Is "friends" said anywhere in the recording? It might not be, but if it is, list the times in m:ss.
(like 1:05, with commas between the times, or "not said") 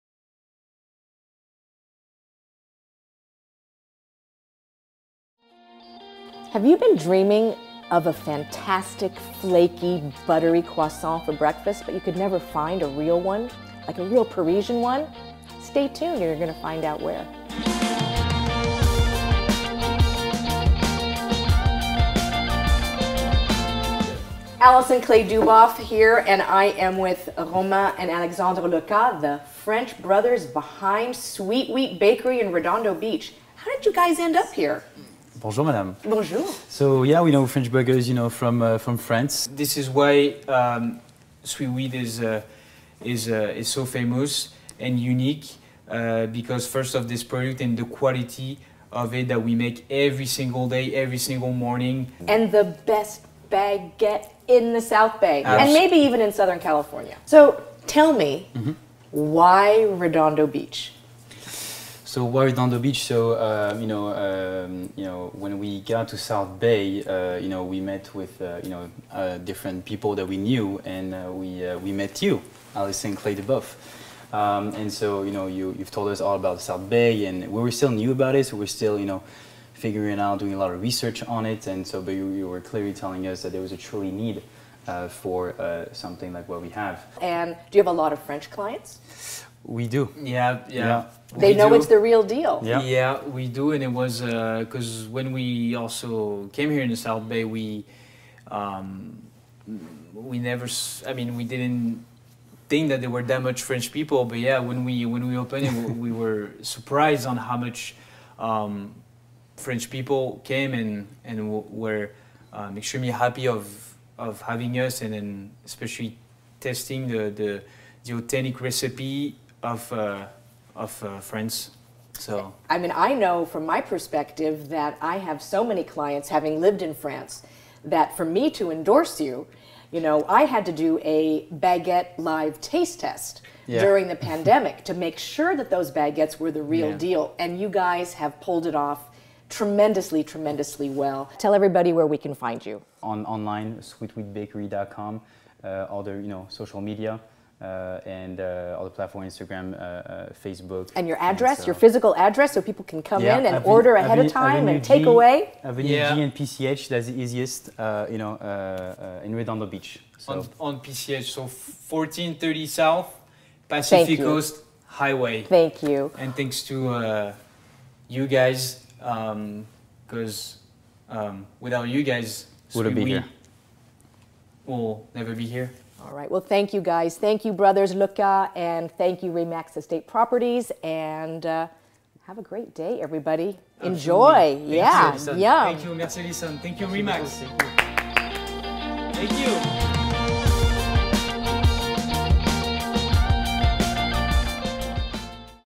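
2:01.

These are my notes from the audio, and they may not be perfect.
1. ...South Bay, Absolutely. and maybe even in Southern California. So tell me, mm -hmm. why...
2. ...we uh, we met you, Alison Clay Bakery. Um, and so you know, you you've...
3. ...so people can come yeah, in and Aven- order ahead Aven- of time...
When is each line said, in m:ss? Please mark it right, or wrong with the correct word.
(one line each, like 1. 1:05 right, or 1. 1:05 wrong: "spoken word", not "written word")
1. 0:54 right
2. 1:11 wrong: "Duboff", not "Bakery"
3. 2:32 right.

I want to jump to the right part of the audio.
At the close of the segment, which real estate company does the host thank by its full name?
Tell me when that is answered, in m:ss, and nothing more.
2:59.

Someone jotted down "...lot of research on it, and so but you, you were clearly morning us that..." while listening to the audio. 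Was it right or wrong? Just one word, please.
wrong.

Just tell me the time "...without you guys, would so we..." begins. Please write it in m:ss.
2:51.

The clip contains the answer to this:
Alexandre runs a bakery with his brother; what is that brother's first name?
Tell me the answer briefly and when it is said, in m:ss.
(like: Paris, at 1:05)
Romain, at 0:27.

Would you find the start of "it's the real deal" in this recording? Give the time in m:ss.
1:31.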